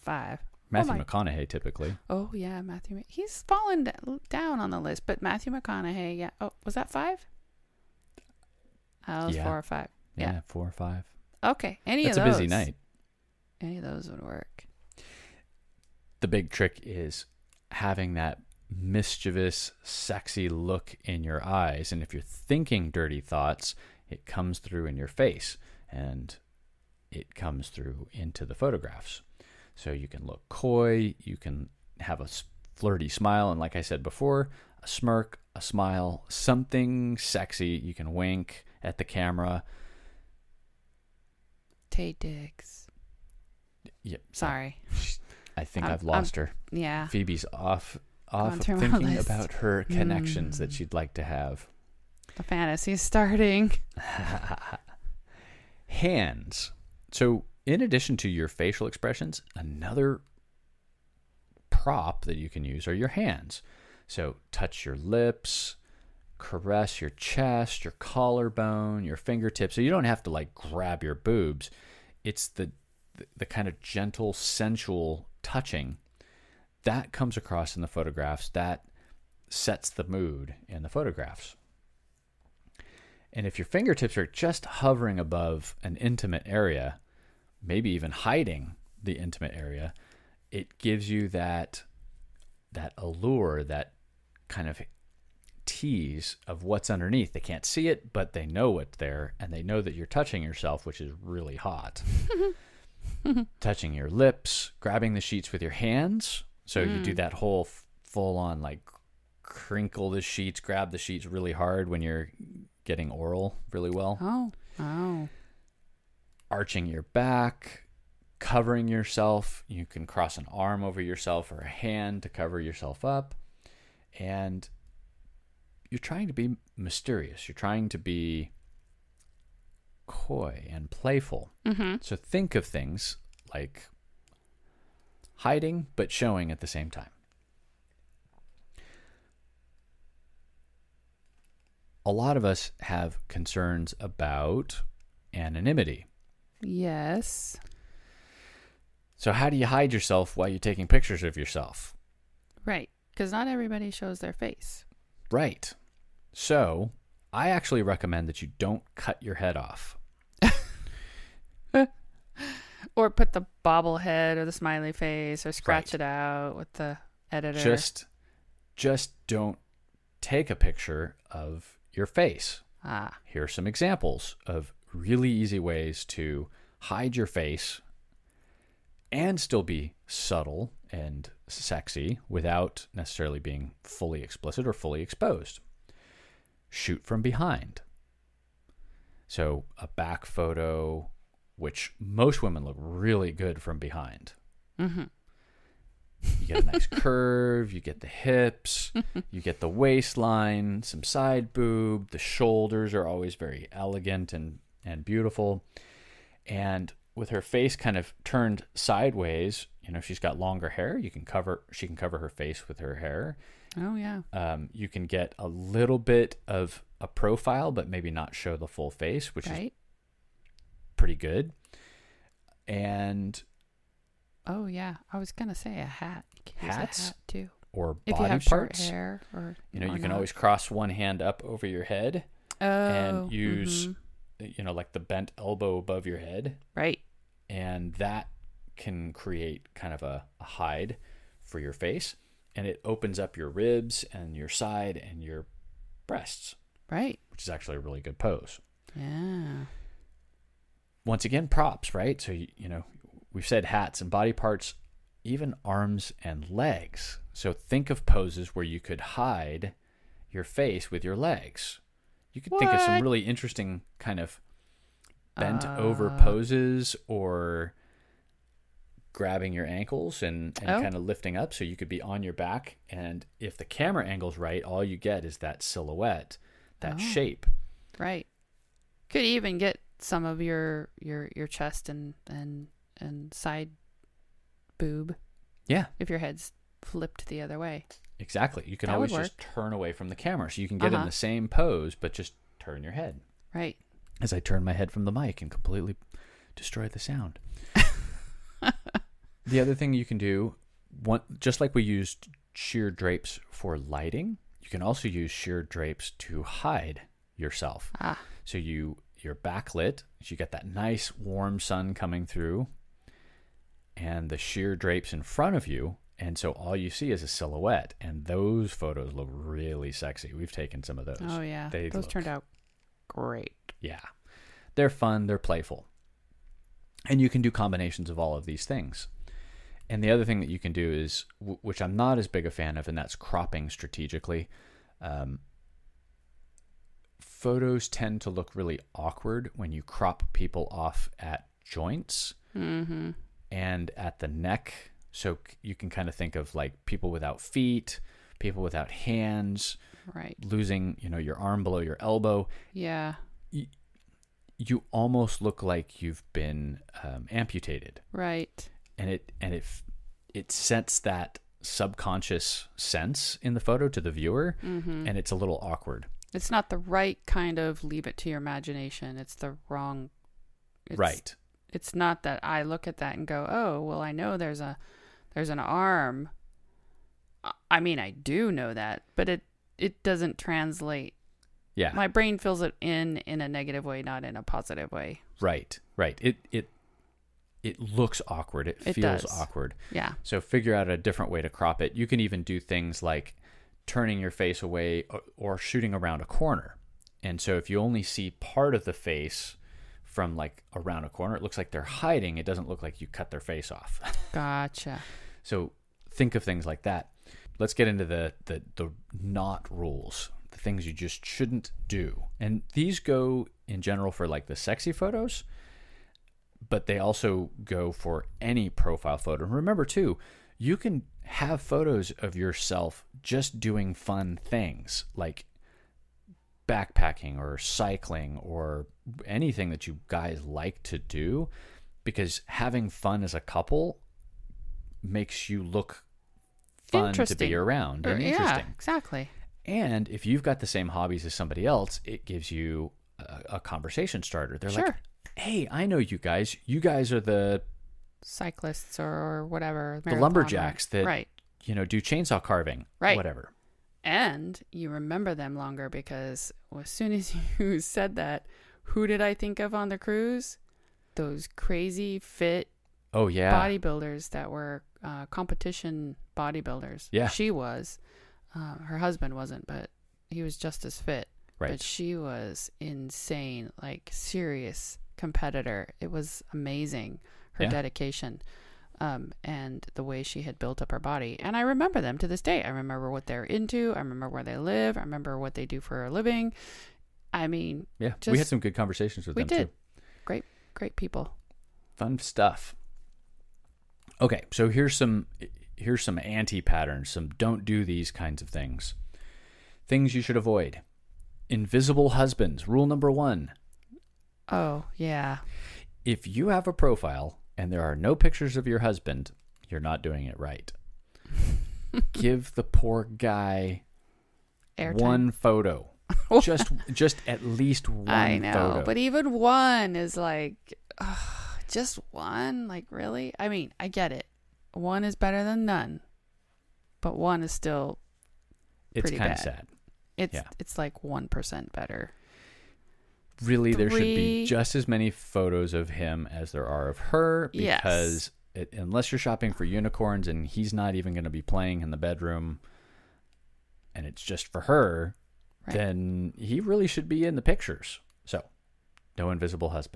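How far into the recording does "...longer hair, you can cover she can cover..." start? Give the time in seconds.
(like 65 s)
210 s.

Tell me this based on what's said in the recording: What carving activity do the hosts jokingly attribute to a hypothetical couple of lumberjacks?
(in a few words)
Chainsaw carving.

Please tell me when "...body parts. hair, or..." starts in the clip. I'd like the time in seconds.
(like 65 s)
228 s.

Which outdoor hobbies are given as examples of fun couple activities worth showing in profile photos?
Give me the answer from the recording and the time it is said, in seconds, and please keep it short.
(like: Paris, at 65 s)
Backpacking or cycling, at 426 s.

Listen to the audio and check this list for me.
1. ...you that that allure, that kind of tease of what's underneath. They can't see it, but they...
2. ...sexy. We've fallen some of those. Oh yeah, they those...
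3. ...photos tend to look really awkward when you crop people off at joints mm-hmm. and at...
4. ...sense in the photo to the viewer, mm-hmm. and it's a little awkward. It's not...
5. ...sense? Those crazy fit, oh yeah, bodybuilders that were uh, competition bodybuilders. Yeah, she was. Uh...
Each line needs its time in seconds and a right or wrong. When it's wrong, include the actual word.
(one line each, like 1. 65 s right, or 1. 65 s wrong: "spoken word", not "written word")
1. 91 s right
2. 319 s wrong: "taken", not "fallen"
3. 337 s right
4. 362 s right
5. 459 s wrong: "cruise", not "sense".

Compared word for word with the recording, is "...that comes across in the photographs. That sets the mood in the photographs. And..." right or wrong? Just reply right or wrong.
right.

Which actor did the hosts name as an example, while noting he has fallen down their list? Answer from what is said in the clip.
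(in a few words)
Matthew McConaughey.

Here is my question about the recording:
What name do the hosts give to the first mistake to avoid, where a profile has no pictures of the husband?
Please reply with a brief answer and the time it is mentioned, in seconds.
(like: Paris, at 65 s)
Invisible husbands, at 501 s.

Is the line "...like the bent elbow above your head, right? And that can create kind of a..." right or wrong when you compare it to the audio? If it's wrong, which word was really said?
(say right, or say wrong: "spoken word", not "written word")
right.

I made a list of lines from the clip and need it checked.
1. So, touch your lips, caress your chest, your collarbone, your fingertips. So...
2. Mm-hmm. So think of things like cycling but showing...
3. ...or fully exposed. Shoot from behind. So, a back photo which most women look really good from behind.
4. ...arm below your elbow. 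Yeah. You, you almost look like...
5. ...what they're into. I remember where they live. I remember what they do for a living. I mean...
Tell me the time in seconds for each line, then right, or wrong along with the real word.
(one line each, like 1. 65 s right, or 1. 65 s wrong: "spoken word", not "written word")
1. 64 s right
2. 131 s wrong: "hiding", not "cycling"
3. 184 s right
4. 351 s right
5. 483 s right.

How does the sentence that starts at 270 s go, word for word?
kind of lifting up so you could be on your back.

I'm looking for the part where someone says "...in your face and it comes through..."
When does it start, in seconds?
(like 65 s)
24 s.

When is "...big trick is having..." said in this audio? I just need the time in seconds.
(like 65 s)
16 s.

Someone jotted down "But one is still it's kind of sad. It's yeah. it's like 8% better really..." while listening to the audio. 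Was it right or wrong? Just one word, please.
wrong.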